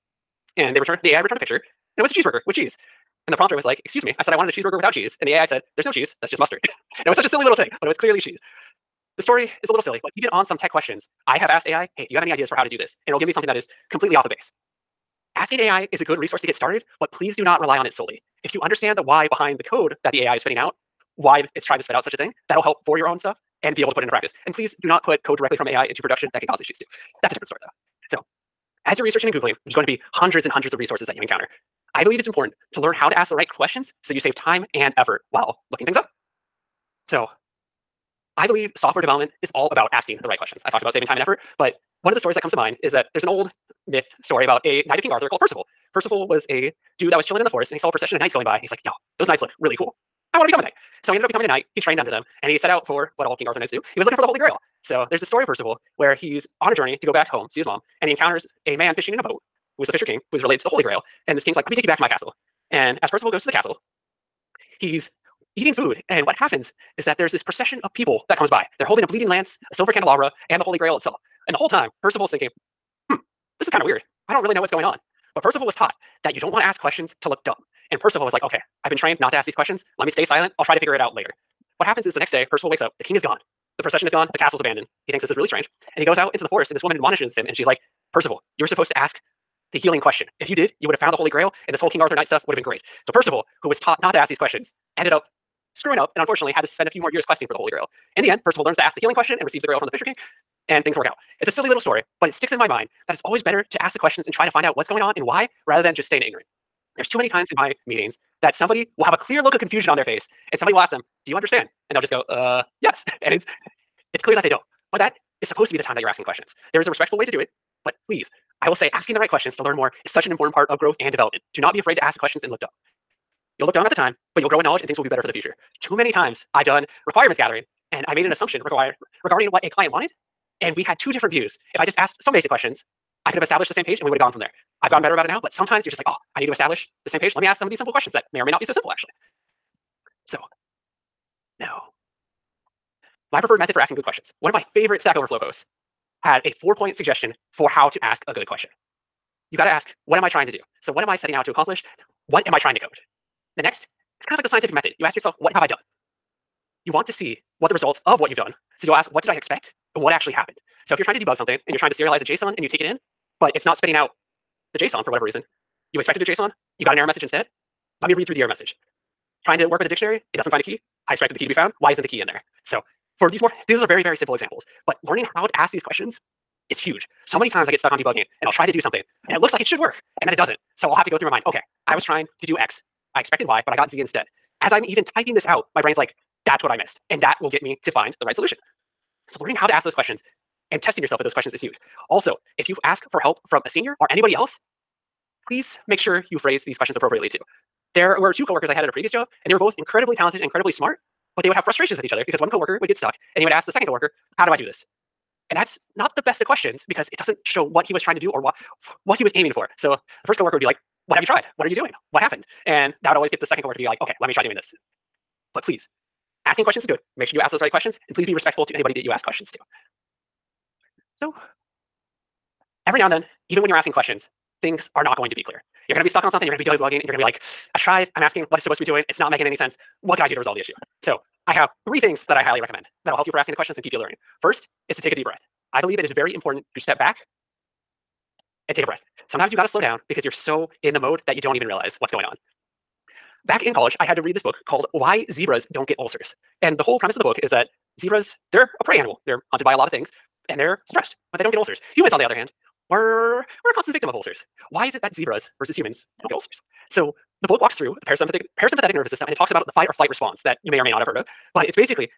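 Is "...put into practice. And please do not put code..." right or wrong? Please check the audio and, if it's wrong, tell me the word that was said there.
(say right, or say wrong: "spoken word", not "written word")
right.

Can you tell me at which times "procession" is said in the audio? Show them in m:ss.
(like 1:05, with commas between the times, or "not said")
0:47, 1:07, 1:23.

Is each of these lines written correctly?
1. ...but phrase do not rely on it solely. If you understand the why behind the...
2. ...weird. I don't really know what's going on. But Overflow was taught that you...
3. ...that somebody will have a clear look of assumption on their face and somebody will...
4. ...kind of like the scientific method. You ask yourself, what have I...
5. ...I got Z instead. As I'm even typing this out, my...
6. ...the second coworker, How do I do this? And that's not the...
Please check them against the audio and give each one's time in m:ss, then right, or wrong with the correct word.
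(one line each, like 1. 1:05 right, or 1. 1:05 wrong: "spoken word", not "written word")
1. 0:17 wrong: "please", not "phrase"
2. 1:13 wrong: "Percival", not "Overflow"
3. 1:48 wrong: "confusion", not "assumption"
4. 2:34 right
5. 3:03 right
6. 3:23 right.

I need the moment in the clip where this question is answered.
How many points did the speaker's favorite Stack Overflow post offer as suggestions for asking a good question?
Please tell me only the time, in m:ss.
2:26.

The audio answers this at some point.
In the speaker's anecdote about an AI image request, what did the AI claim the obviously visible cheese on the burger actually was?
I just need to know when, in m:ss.
0:06.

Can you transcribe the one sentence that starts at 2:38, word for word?
So you'll ask, what did I expect?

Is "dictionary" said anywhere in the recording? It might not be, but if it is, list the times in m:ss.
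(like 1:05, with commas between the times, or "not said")
2:49.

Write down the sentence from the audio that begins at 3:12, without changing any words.
Also, if you ask for help from a senior or anybody else, please make sure you phrase these questions appropriately too.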